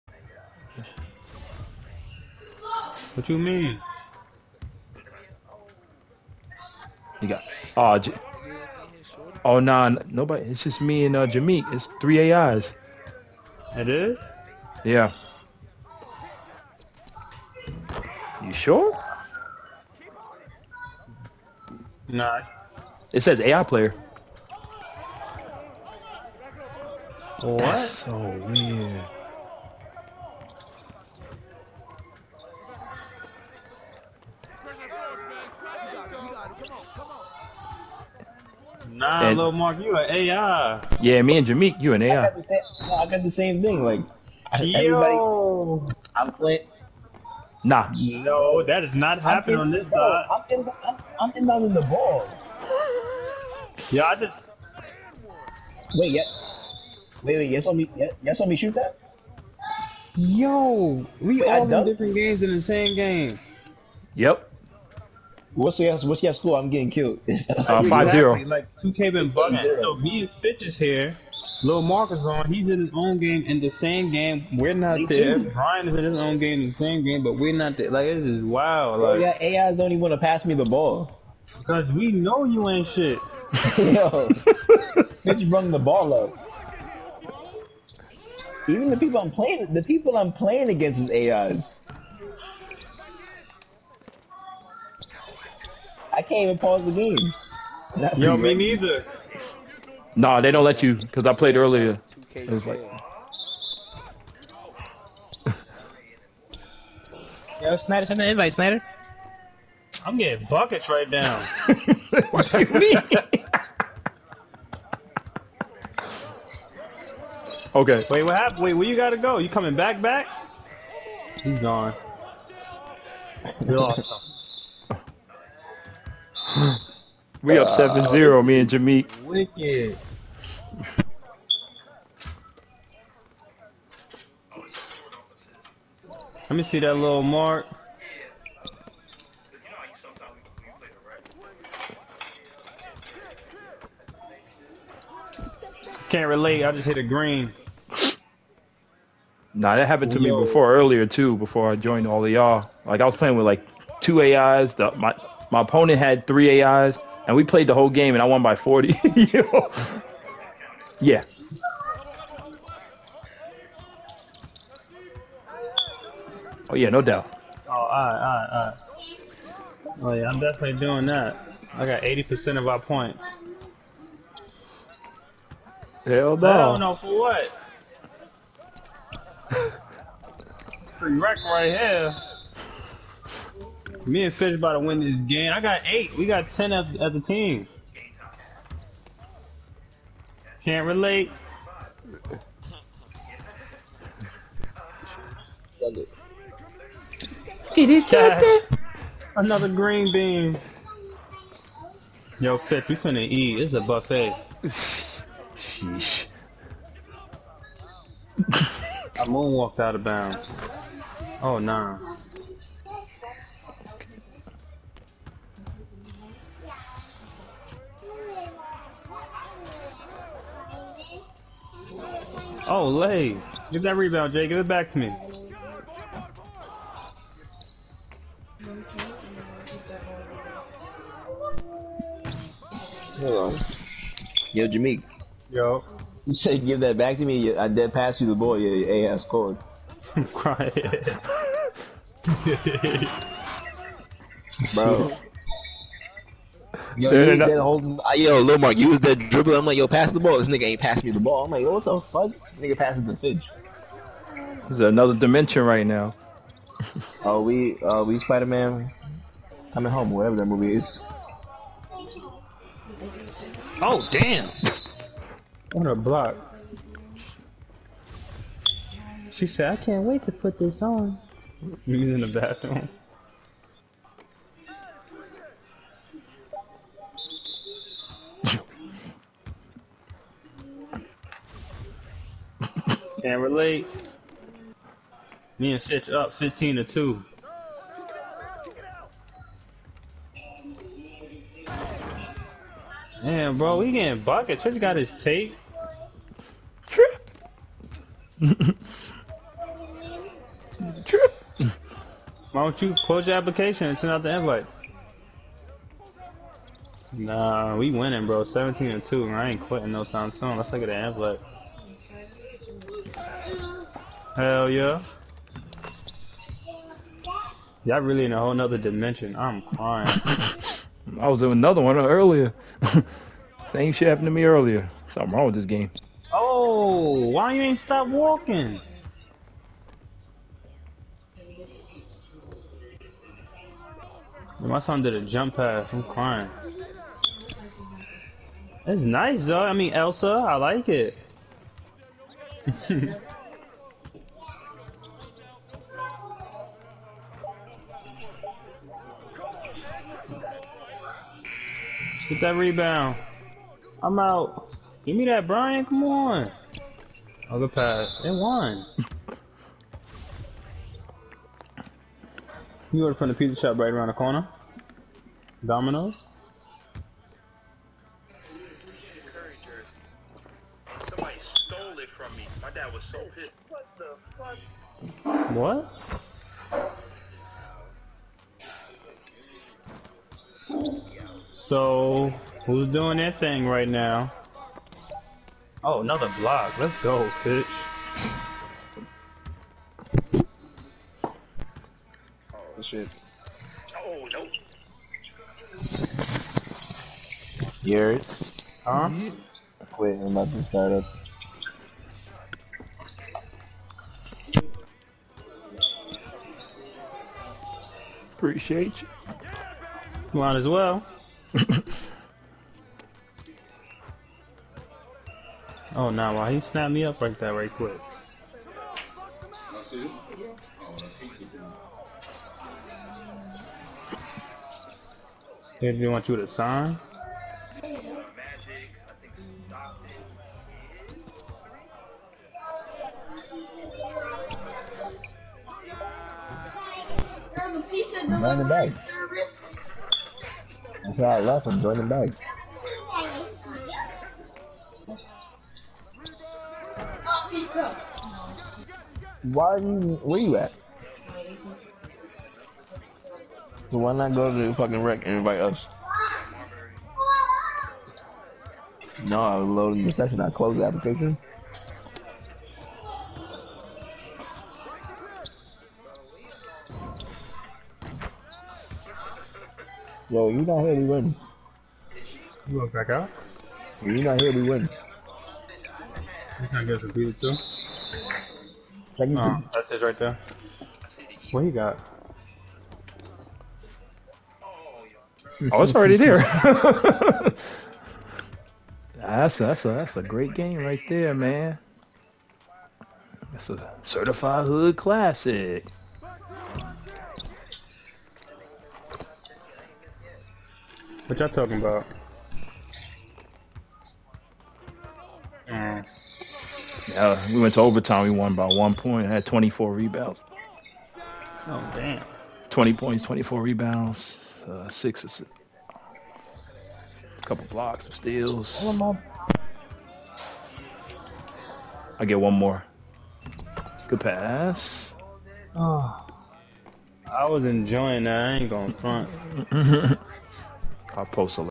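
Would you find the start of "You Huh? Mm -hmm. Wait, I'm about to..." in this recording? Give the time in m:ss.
6:37.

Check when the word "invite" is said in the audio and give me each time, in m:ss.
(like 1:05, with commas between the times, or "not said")
1:48, 5:04, 7:35.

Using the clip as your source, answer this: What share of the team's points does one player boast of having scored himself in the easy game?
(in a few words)
80%.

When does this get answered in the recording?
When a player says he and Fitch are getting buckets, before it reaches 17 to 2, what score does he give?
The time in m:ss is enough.
4:46.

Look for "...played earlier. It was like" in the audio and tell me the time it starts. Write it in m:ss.
1:41.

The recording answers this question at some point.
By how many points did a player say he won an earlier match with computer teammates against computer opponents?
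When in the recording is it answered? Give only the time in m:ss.
2:38.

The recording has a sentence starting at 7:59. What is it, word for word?
Can you oh, that's his right there.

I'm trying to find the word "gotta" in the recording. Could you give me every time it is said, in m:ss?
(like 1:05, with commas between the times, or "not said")
1:58.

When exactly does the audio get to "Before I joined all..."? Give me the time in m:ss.
2:31.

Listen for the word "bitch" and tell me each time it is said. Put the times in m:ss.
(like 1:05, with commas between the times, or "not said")
1:25, 6:27.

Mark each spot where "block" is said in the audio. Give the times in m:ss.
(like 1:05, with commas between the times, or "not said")
4:25, 6:26, 8:37.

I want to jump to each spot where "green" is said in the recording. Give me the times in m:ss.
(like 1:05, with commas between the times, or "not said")
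2:27, 3:19.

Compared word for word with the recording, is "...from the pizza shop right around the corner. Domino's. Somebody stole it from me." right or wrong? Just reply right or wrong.
right.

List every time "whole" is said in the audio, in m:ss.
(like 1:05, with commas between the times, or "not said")
2:37, 5:18.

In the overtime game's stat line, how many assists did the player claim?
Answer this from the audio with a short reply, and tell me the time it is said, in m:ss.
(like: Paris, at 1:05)
6, at 8:34.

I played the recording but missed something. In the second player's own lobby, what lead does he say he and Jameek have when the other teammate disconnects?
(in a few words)
7-0.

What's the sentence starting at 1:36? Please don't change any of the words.
I can't even pause the game.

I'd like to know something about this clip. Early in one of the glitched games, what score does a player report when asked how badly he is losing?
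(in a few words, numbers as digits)
5-0.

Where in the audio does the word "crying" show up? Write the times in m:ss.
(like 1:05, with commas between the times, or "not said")
4:00, 5:19, 5:36.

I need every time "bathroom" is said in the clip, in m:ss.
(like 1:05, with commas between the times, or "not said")
4:32.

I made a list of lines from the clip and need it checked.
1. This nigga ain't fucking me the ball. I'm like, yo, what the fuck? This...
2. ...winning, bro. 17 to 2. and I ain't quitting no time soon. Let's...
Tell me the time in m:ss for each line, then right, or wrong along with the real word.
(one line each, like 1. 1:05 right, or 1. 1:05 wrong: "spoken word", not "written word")
1. 4:10 wrong: "passing", not "fucking"
2. 5:07 right.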